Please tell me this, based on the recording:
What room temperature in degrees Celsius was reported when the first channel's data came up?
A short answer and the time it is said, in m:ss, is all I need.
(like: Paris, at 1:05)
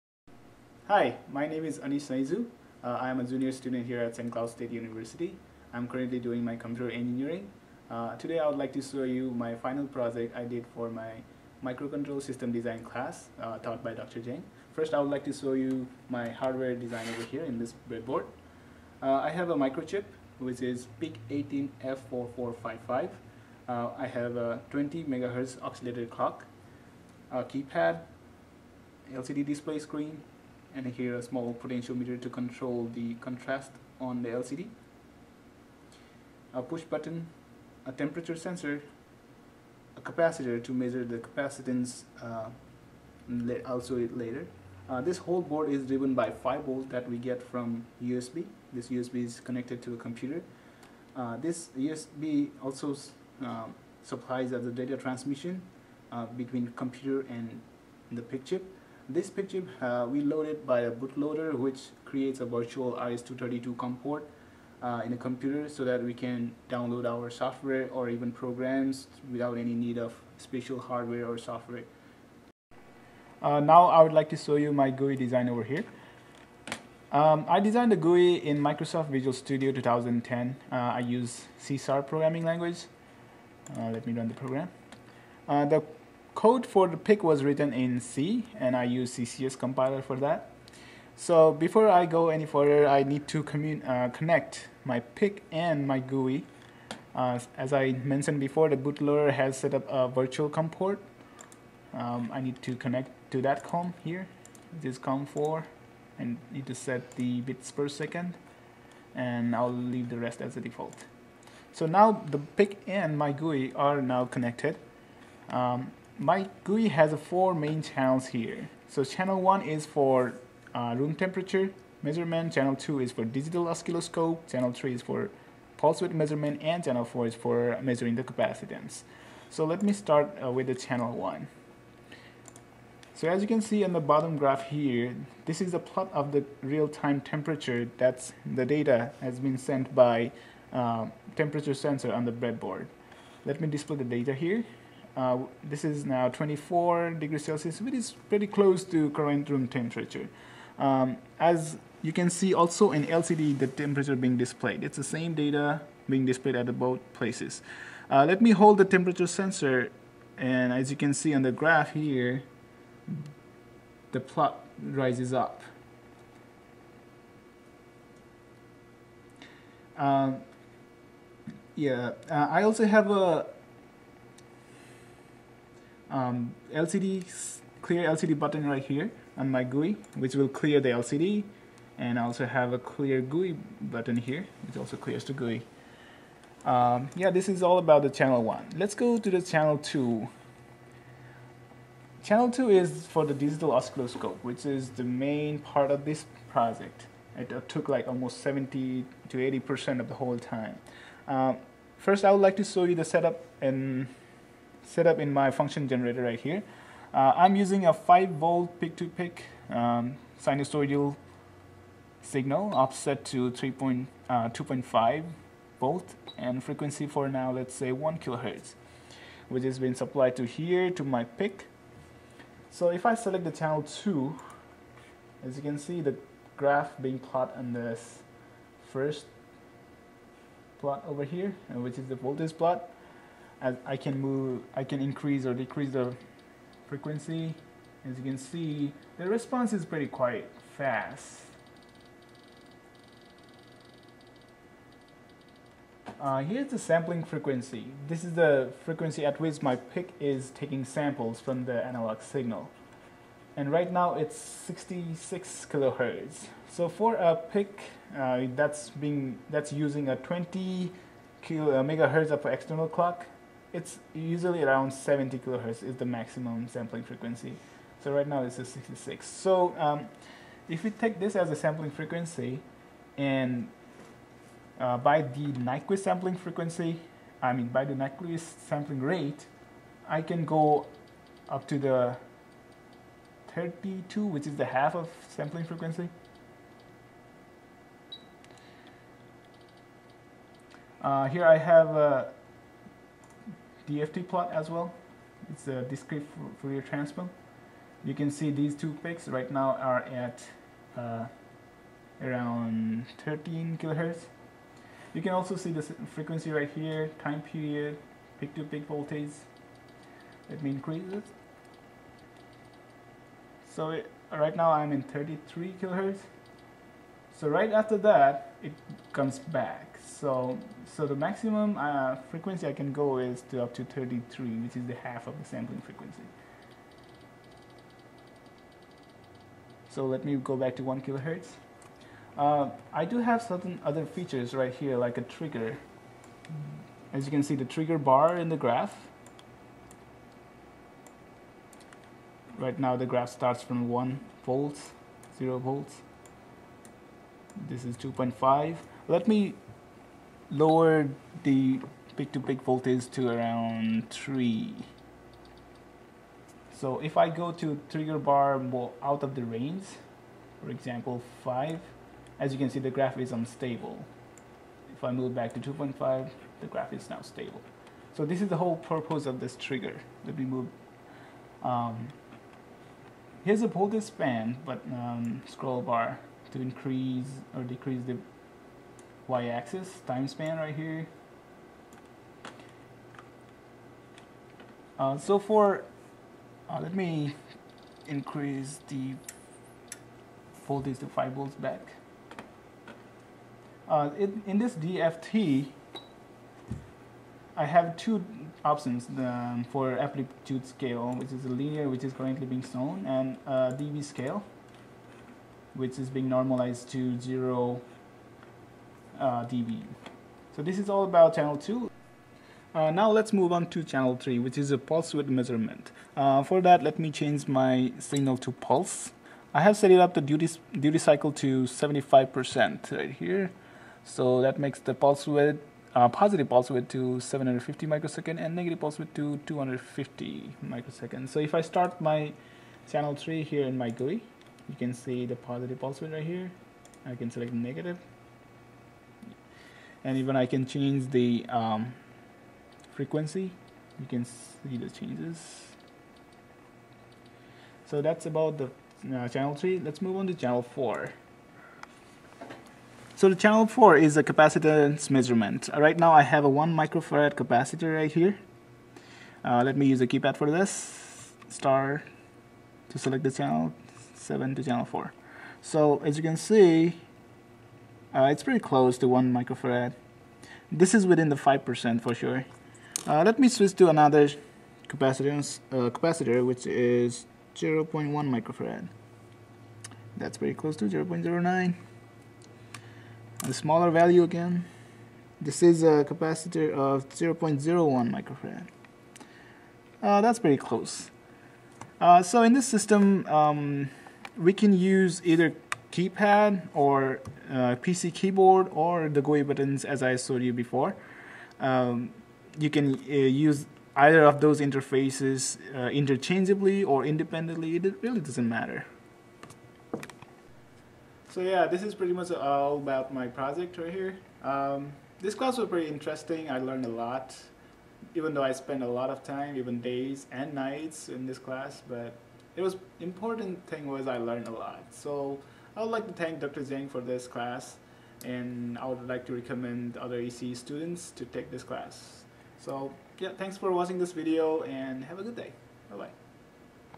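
24 degrees Celsius, at 2:26.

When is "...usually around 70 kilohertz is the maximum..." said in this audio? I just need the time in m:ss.
4:24.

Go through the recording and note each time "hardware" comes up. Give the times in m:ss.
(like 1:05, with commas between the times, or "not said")
0:16, 1:10.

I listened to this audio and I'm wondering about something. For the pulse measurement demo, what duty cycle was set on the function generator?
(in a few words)
75%.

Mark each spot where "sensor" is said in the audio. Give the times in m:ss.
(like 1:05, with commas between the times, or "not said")
0:38, 2:21, 2:39.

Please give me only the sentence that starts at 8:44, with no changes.
So I would like to thank Dr.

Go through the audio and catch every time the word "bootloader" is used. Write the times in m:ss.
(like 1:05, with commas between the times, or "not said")
1:00, 1:38.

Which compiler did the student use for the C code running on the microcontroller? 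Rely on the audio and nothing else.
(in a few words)
CCS.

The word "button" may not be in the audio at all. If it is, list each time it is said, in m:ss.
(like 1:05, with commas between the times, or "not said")
0:36, 2:58, 3:03, 8:19.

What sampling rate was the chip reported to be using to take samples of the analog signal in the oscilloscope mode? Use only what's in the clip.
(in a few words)
66 kilohertz.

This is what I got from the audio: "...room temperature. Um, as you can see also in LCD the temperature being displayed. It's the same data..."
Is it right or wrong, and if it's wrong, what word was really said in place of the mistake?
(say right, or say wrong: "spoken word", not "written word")
right.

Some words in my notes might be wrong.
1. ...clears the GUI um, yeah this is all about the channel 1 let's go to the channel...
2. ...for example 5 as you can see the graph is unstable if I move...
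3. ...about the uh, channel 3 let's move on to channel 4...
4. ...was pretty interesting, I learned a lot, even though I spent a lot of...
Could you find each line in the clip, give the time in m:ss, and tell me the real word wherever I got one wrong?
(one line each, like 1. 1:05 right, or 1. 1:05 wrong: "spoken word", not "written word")
1. 3:04 right
2. 6:00 right
3. 7:28 right
4. 8:35 right.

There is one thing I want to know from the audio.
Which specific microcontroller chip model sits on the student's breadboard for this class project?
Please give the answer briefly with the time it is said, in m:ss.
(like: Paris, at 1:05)
PIC18F4455, at 0:21.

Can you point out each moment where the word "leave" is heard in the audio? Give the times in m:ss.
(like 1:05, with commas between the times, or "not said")
1:49.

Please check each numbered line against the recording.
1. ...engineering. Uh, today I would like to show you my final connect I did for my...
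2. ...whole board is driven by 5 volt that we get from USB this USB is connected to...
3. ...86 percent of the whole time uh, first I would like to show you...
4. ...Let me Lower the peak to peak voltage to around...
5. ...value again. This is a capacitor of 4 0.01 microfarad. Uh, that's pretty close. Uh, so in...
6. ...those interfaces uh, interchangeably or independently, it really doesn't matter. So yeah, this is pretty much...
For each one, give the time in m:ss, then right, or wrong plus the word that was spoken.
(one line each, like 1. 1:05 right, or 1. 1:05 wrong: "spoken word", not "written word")
1. 0:06 wrong: "project", not "connect"
2. 0:45 right
3. 3:19 wrong: "80", not "86"
4. 5:49 right
5. 8:03 wrong: "0", not "4"
6. 8:24 right.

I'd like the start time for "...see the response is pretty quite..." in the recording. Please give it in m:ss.
3:58.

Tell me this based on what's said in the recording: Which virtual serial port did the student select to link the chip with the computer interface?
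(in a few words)
COM4.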